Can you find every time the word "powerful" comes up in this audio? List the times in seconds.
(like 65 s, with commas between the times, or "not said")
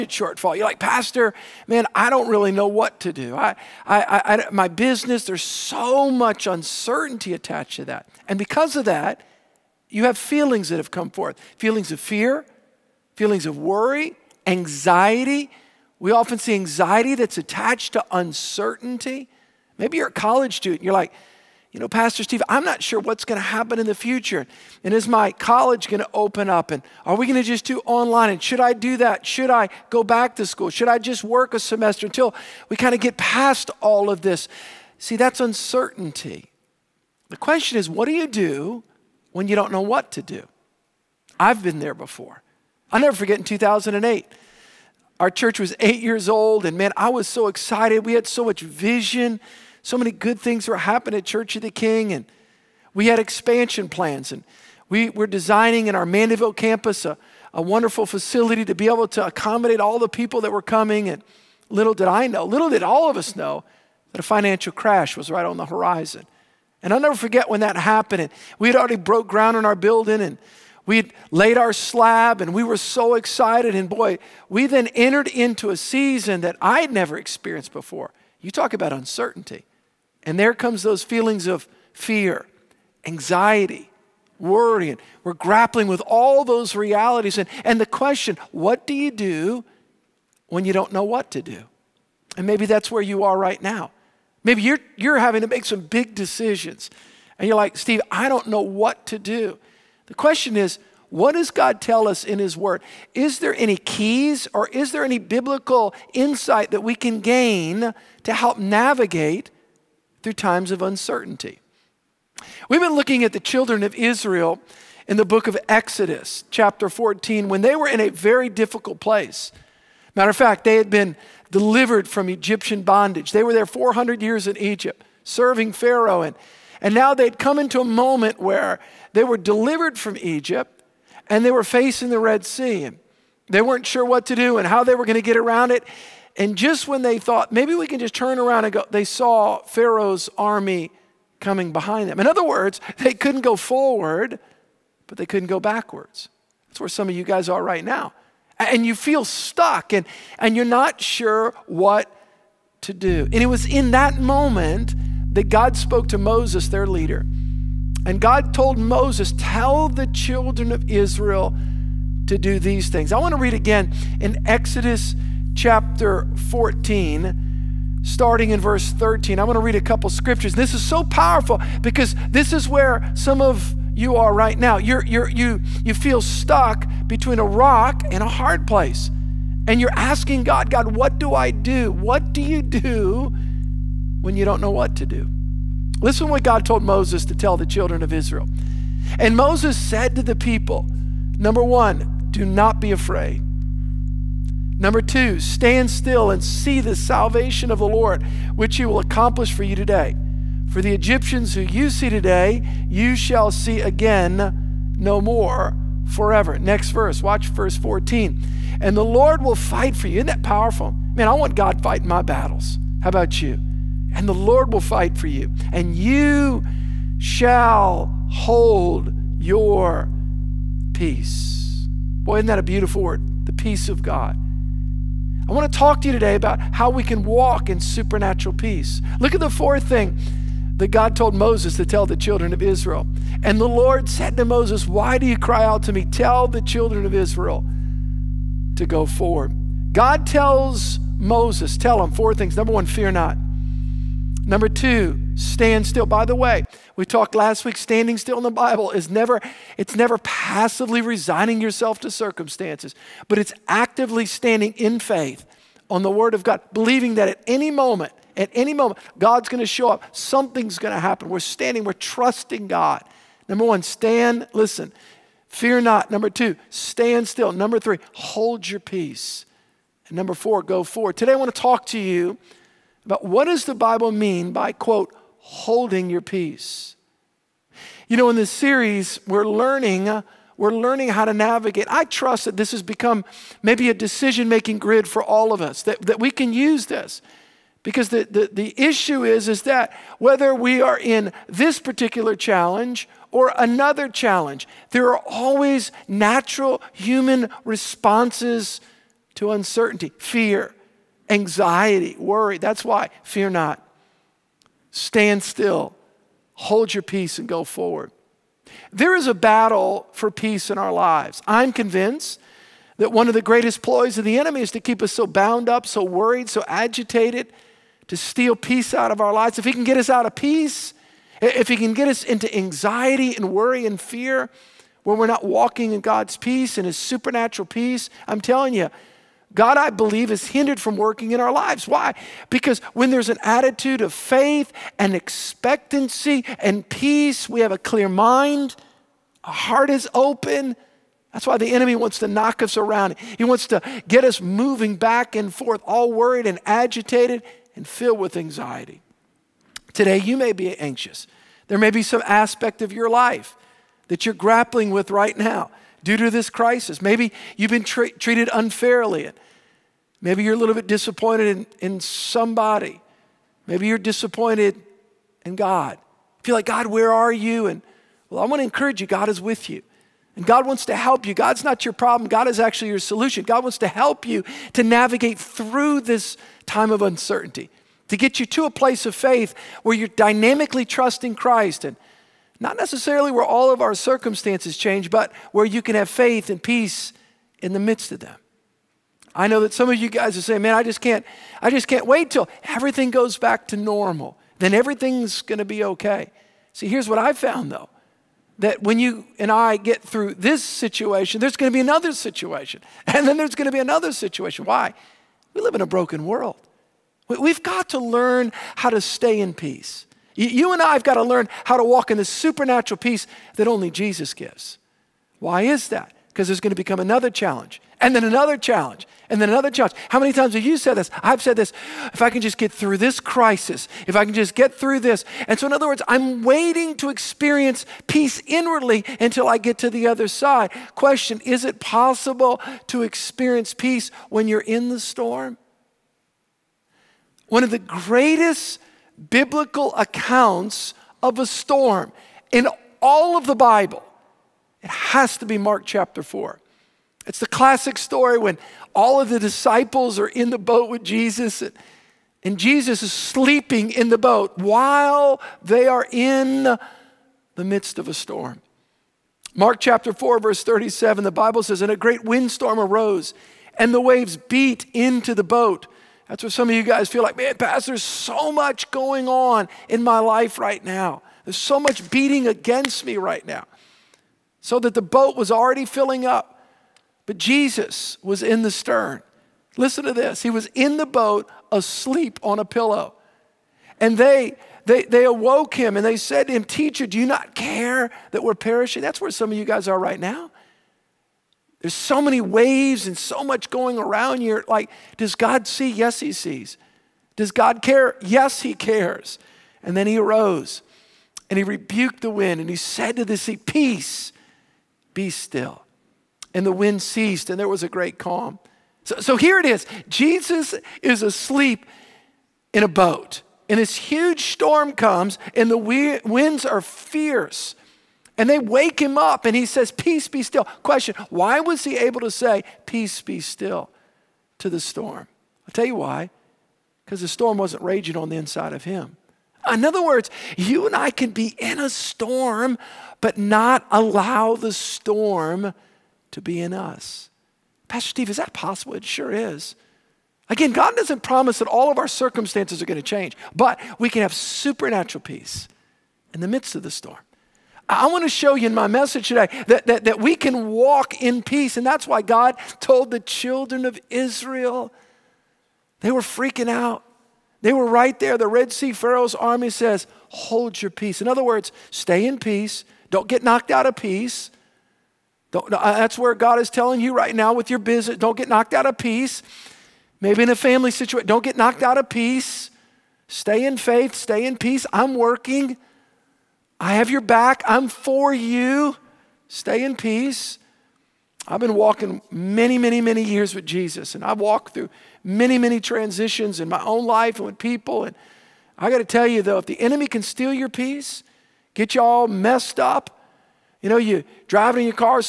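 171 s, 210 s.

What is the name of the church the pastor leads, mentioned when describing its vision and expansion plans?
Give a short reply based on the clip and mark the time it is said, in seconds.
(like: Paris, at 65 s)
Church of the King, at 51 s.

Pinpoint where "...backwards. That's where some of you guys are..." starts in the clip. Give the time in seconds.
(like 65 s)
145 s.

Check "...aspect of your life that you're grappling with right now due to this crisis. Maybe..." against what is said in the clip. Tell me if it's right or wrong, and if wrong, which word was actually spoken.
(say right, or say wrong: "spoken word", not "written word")
right.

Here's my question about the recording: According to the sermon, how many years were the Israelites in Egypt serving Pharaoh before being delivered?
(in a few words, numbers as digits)
400.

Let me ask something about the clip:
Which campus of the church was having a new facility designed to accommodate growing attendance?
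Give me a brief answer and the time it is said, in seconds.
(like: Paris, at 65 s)
Mandeville, at 56 s.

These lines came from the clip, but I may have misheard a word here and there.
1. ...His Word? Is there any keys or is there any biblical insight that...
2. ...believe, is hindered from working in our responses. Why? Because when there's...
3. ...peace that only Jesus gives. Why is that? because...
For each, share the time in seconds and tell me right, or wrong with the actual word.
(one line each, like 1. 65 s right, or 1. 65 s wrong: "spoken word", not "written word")
1. 102 s right
2. 329 s wrong: "lives", not "responses"
3. 412 s right.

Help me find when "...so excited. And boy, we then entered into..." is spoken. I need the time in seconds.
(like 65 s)
72 s.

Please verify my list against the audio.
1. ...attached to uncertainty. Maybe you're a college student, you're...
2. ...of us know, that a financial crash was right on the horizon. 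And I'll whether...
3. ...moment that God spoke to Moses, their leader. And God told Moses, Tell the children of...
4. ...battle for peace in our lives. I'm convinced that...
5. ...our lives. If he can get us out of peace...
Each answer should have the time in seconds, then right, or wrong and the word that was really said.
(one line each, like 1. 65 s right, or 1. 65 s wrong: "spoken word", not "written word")
1. 17 s right
2. 63 s wrong: "never", not "whether"
3. 154 s right
4. 309 s right
5. 319 s right.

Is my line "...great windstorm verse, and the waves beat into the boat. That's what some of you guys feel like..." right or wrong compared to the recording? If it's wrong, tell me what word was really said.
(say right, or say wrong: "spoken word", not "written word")
wrong: "arose", not "verse".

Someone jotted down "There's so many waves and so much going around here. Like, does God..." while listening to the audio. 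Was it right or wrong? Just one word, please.
right.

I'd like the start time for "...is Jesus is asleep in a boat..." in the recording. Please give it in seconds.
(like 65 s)
509 s.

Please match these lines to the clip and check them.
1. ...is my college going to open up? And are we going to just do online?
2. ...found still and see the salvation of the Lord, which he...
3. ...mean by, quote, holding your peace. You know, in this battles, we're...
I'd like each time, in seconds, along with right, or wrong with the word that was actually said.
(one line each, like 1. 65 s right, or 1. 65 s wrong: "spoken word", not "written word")
1. 24 s right
2. 195 s wrong: "stand", not "found"
3. 274 s wrong: "series", not "battles".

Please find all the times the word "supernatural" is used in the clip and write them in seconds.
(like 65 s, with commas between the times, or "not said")
227 s, 326 s, 412 s, 544 s.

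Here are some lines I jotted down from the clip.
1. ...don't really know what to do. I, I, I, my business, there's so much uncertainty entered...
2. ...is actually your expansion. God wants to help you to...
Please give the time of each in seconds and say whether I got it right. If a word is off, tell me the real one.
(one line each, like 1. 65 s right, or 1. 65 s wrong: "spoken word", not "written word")
1. 2 s wrong: "attached", not "entered"
2. 372 s wrong: "solution", not "expansion".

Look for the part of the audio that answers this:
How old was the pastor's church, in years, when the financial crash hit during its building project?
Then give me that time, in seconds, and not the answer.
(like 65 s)
45 s.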